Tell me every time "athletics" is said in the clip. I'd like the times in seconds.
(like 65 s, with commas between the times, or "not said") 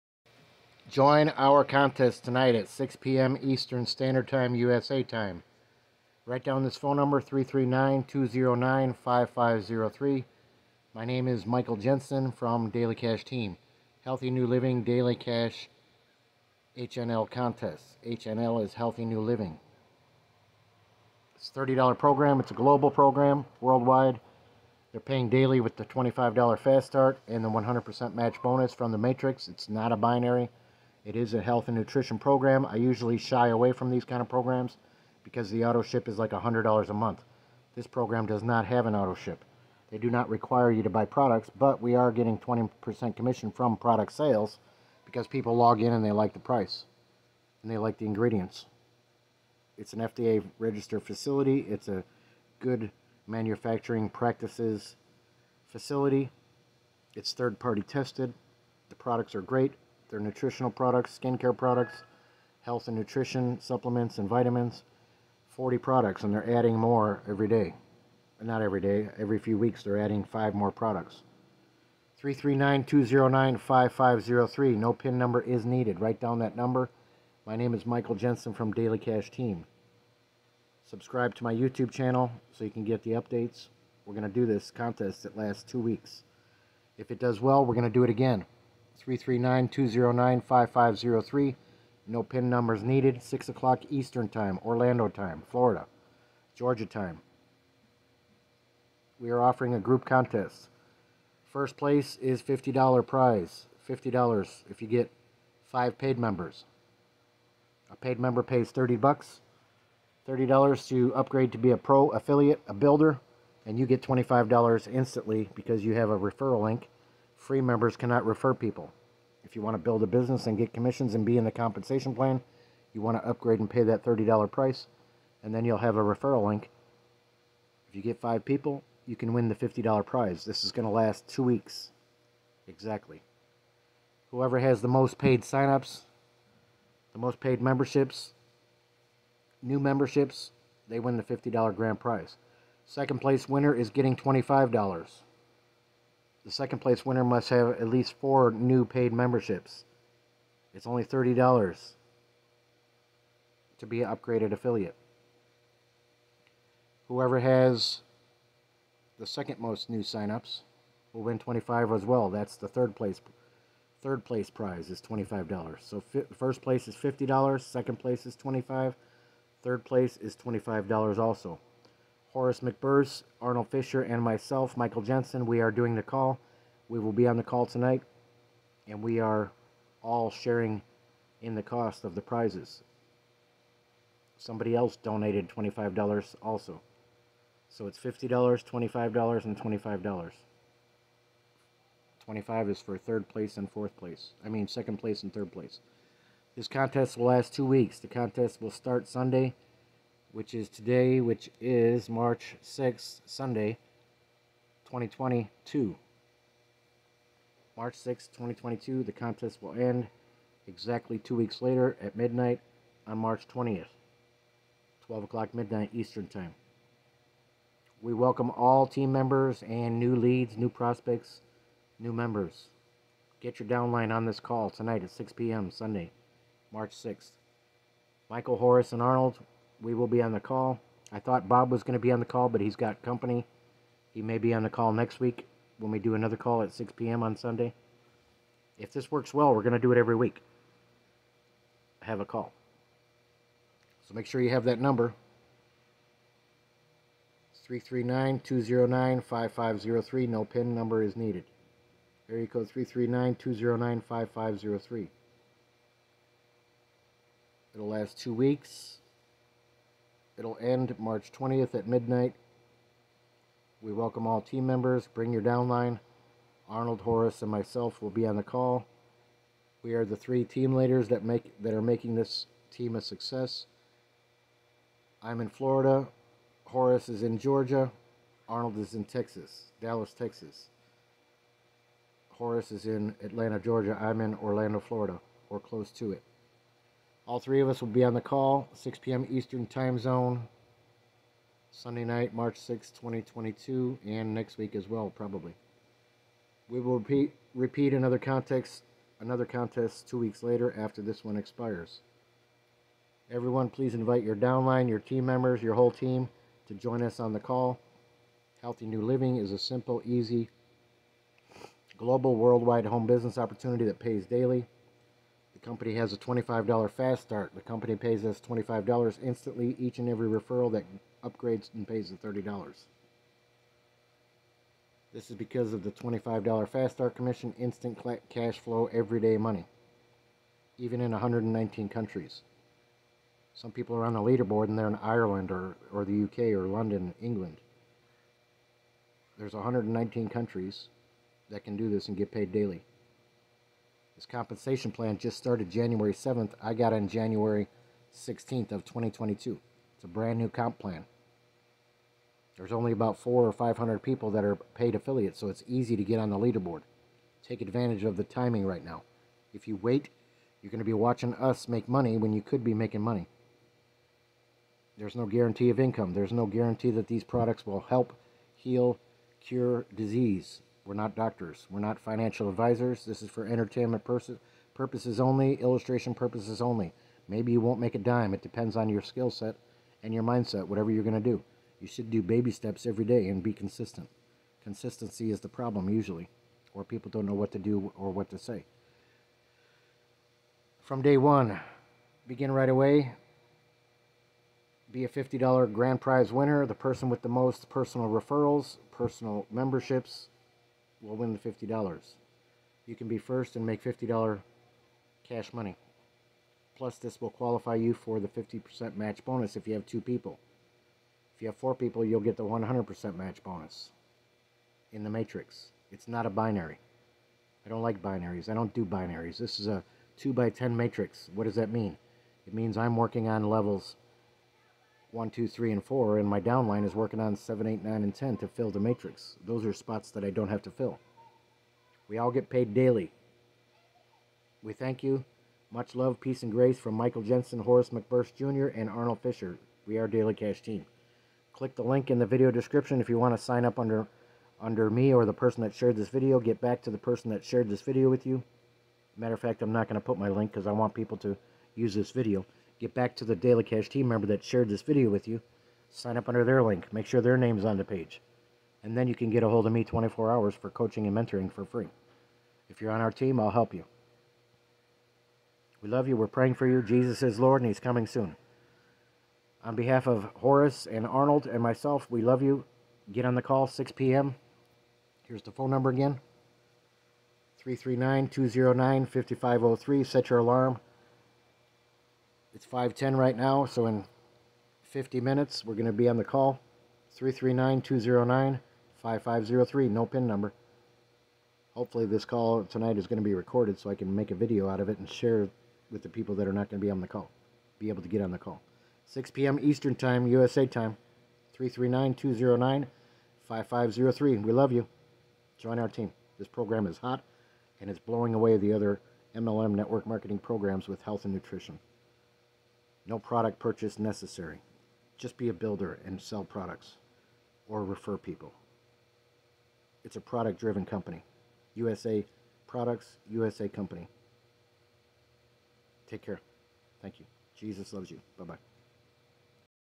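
not said.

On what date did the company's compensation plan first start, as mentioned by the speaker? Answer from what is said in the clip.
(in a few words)
January 7th.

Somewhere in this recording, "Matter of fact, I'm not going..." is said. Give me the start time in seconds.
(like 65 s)
449 s.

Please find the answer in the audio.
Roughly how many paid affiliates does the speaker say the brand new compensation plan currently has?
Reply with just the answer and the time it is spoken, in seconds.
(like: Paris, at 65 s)
400 or 500, at 353 s.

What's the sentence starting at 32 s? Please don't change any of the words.
I usually shy away from these kind of programs because the auto ship is like $100 a month.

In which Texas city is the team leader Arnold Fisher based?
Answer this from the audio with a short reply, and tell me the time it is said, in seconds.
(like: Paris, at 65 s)
Dallas, at 279 s.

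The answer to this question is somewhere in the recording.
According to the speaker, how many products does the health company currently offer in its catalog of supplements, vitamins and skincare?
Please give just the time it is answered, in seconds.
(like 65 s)
65 s.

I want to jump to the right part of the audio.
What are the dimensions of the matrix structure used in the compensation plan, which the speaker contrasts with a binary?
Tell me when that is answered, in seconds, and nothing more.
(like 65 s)
420 s.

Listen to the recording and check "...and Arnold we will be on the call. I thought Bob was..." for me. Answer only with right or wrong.
right.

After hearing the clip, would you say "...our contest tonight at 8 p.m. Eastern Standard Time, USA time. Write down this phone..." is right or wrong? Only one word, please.
wrong.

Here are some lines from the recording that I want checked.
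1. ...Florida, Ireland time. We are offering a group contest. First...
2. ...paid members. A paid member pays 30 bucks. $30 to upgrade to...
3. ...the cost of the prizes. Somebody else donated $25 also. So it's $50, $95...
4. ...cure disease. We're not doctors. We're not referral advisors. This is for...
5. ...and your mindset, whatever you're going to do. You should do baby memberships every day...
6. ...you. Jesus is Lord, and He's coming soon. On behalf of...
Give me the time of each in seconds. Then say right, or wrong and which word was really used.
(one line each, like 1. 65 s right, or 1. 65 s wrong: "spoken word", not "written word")
1. 95 s wrong: "Georgia", not "Ireland"
2. 105 s right
3. 181 s wrong: "25", not "95"
4. 369 s wrong: "financial", not "referral"
5. 380 s wrong: "steps", not "memberships"
6. 466 s right.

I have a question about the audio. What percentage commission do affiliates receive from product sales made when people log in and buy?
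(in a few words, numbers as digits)
20%.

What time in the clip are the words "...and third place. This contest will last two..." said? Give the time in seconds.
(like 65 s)
195 s.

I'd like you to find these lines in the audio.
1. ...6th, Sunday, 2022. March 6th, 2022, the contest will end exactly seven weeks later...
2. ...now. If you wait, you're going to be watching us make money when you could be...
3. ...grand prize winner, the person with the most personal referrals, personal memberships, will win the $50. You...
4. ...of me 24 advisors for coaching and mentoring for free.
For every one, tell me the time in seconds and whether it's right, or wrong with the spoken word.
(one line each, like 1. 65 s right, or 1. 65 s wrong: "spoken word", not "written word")
1. 202 s wrong: "two", not "seven"
2. 358 s right
3. 395 s right
4. 459 s wrong: "hours", not "advisors".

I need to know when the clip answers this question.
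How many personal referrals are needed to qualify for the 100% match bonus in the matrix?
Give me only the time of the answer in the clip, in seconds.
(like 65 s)
411 s.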